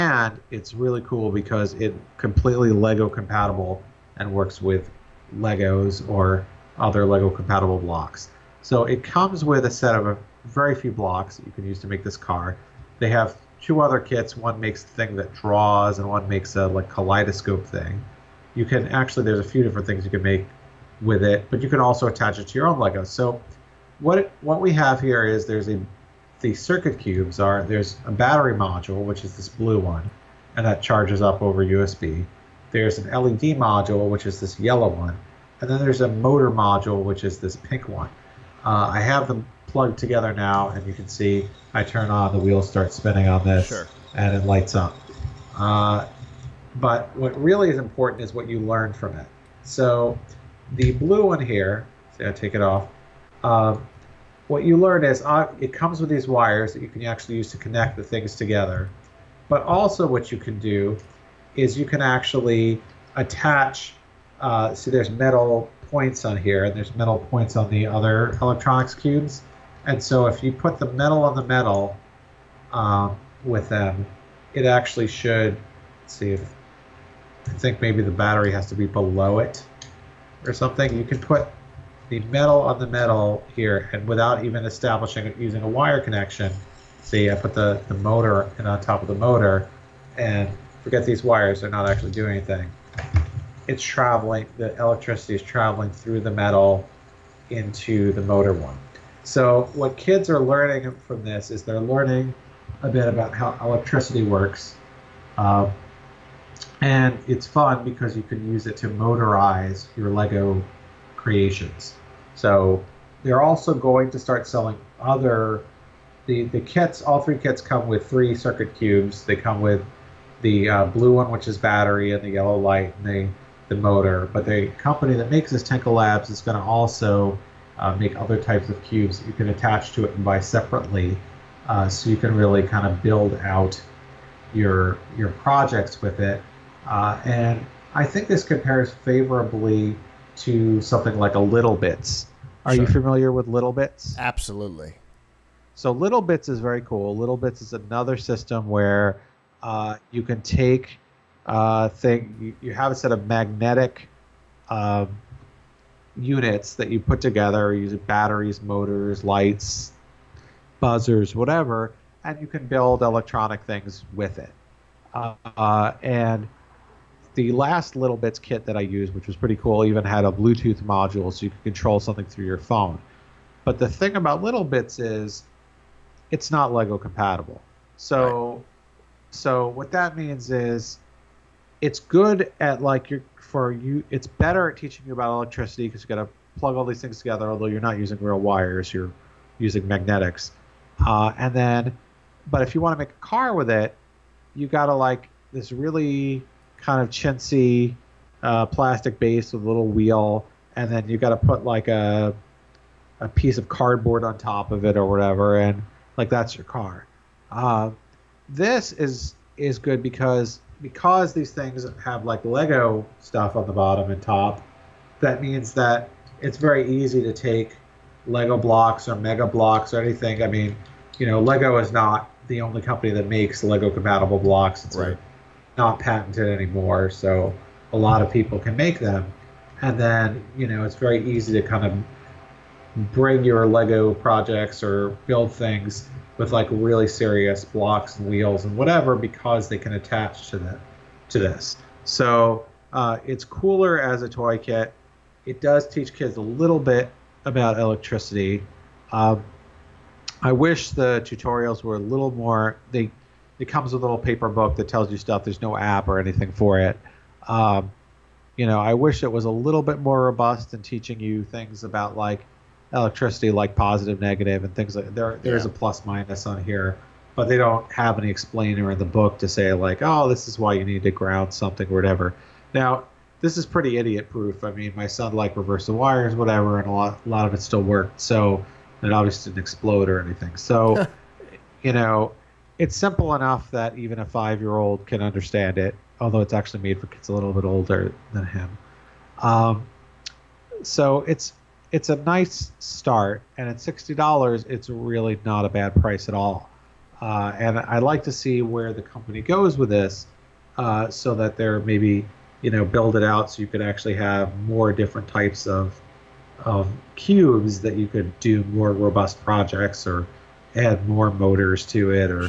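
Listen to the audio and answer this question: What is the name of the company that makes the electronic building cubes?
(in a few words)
Tenka Labs.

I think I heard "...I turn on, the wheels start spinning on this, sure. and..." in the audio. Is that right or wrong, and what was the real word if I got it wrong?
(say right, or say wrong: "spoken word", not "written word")
right.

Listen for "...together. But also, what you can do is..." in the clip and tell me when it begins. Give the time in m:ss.
0:58.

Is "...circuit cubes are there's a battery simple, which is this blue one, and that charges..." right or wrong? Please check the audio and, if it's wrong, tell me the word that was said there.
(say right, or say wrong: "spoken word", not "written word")
wrong: "module", not "simple".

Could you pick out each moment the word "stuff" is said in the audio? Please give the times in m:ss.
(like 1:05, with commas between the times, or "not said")
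3:33, 4:15.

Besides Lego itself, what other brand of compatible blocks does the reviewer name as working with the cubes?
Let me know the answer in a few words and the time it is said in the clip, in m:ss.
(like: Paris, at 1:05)
Mega Blocks, at 3:39.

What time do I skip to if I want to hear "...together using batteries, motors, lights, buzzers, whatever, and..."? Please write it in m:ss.
2:37.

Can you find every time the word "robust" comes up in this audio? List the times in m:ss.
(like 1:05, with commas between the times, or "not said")
4:20, 5:08.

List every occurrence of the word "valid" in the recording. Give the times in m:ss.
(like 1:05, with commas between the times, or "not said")
not said.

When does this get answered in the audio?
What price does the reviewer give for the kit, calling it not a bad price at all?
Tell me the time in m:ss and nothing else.
4:53.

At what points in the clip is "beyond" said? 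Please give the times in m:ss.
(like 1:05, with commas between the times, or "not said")
not said.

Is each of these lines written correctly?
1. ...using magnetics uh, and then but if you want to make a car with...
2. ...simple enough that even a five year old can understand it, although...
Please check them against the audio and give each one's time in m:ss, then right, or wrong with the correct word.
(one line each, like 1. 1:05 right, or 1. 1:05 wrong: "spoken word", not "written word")
1. 3:09 right
2. 4:42 right.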